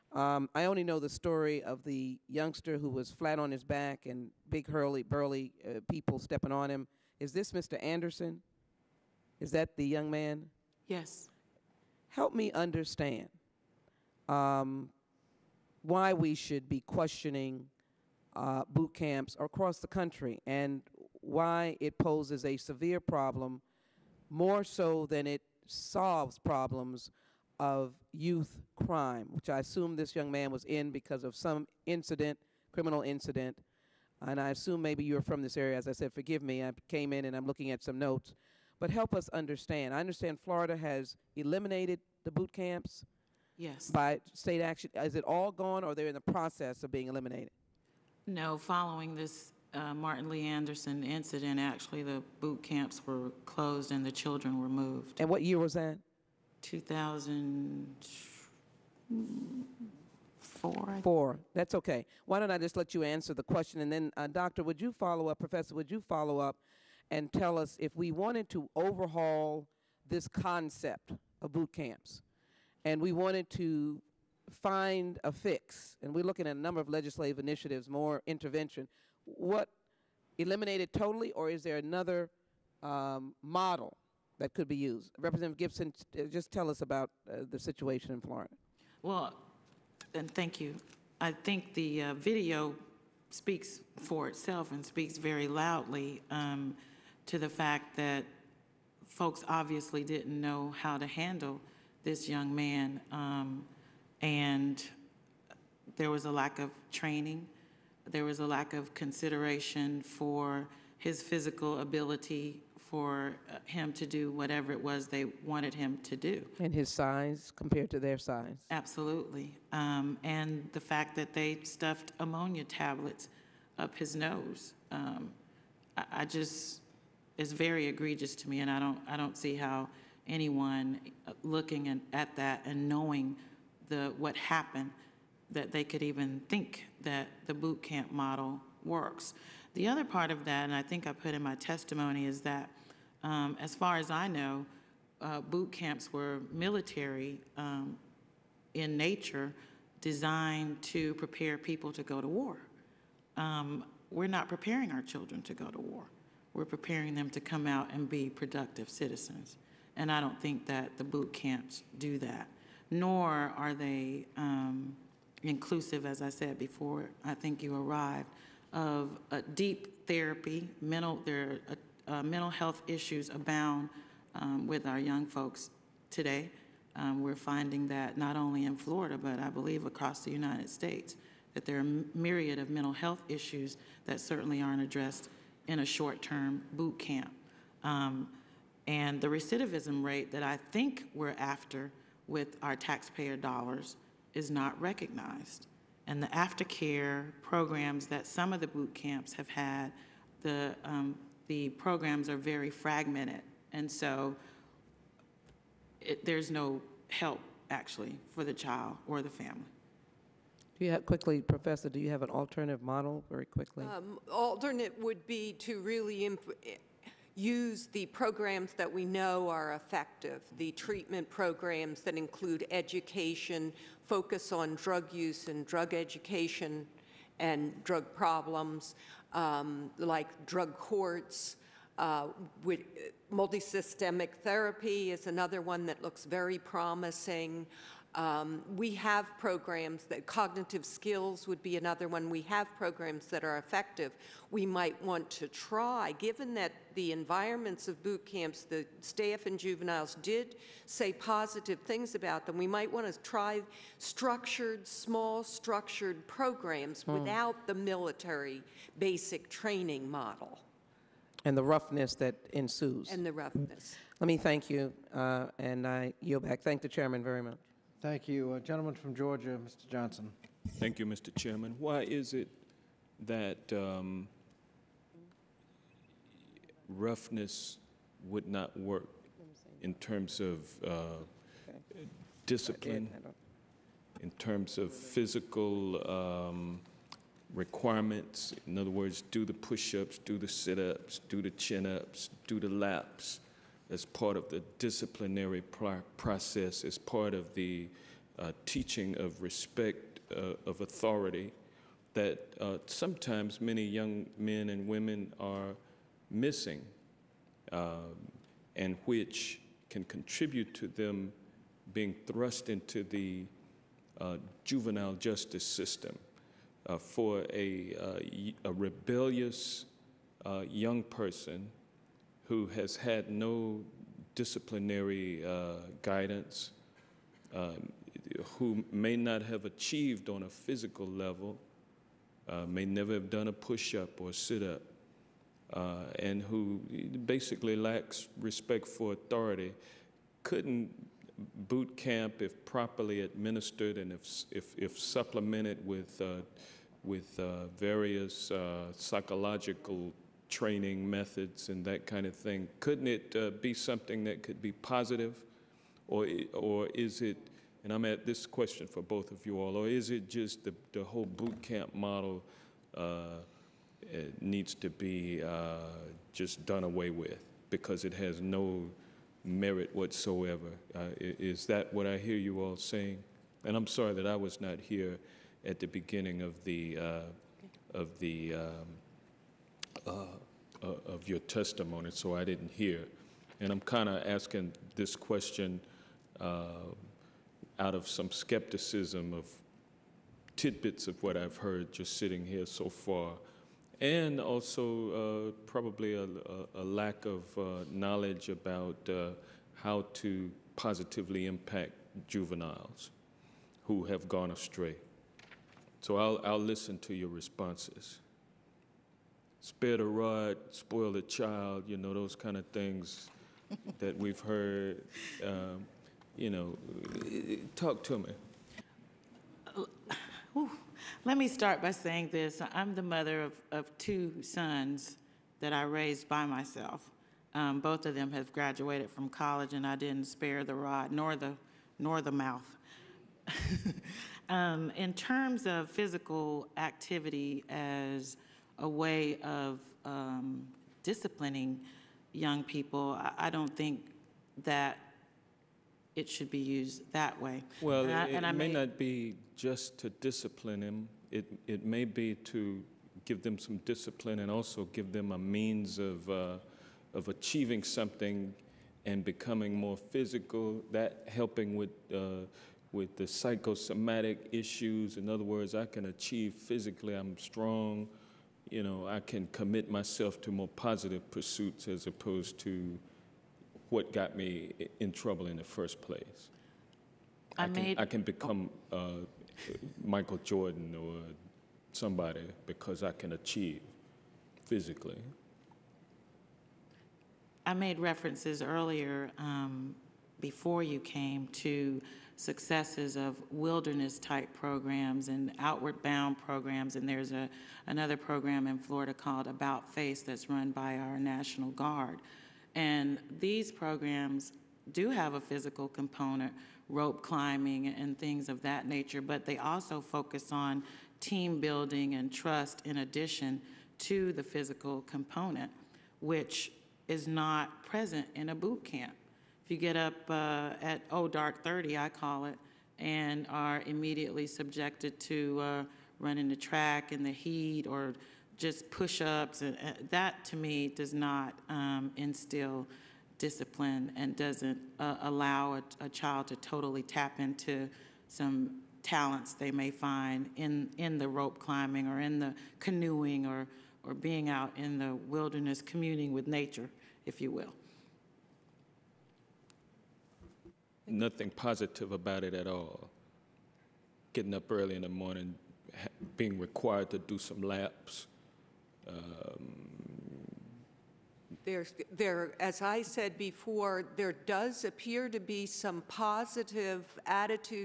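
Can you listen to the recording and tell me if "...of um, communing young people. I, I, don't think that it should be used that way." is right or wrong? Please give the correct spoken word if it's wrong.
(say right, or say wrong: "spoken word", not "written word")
wrong: "disciplining", not "communing".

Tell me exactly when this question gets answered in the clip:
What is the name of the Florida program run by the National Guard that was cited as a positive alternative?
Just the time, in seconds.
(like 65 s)
499 s.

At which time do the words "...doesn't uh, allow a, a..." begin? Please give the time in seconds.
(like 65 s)
534 s.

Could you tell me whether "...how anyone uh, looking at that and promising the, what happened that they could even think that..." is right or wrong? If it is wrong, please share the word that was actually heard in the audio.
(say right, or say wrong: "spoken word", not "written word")
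wrong: "knowing", not "promising".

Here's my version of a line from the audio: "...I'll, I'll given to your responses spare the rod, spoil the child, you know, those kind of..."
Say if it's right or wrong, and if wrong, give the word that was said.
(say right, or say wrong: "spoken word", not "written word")
wrong: "listen", not "given".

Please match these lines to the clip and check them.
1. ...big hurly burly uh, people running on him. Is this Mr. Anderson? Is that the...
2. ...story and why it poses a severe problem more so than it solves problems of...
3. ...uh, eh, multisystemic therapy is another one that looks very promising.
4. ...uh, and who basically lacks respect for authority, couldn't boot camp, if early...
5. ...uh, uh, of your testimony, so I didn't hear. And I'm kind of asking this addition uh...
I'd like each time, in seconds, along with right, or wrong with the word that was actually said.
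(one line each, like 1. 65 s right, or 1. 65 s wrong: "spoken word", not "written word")
1. 4 s wrong: "stepping", not "running"
2. 19 s wrong: "country", not "story"
3. 231 s right
4. 335 s wrong: "properly", not "early"
5. 380 s wrong: "question", not "addition".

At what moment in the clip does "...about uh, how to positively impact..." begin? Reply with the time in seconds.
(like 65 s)
398 s.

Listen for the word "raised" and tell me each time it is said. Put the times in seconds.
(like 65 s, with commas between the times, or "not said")
425 s.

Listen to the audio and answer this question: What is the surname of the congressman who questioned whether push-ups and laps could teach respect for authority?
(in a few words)
Johnson.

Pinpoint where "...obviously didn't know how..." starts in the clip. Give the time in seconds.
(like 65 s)
99 s.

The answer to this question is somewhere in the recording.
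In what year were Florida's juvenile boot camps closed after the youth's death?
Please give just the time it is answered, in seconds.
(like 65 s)
56 s.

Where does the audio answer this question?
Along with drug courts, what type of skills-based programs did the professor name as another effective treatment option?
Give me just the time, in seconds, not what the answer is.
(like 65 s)
240 s.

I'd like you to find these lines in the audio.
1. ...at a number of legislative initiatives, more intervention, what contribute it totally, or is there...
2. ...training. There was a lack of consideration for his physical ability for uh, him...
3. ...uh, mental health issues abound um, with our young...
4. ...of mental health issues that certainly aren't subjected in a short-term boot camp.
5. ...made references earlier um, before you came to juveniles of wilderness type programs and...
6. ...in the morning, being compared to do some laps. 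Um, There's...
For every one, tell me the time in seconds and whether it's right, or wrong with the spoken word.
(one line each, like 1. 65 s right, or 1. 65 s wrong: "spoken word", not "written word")
1. 76 s wrong: "eliminate", not "contribute"
2. 106 s right
3. 172 s right
4. 182 s wrong: "addressed", not "subjected"
5. 487 s wrong: "successes", not "juveniles"
6. 554 s wrong: "required", not "compared".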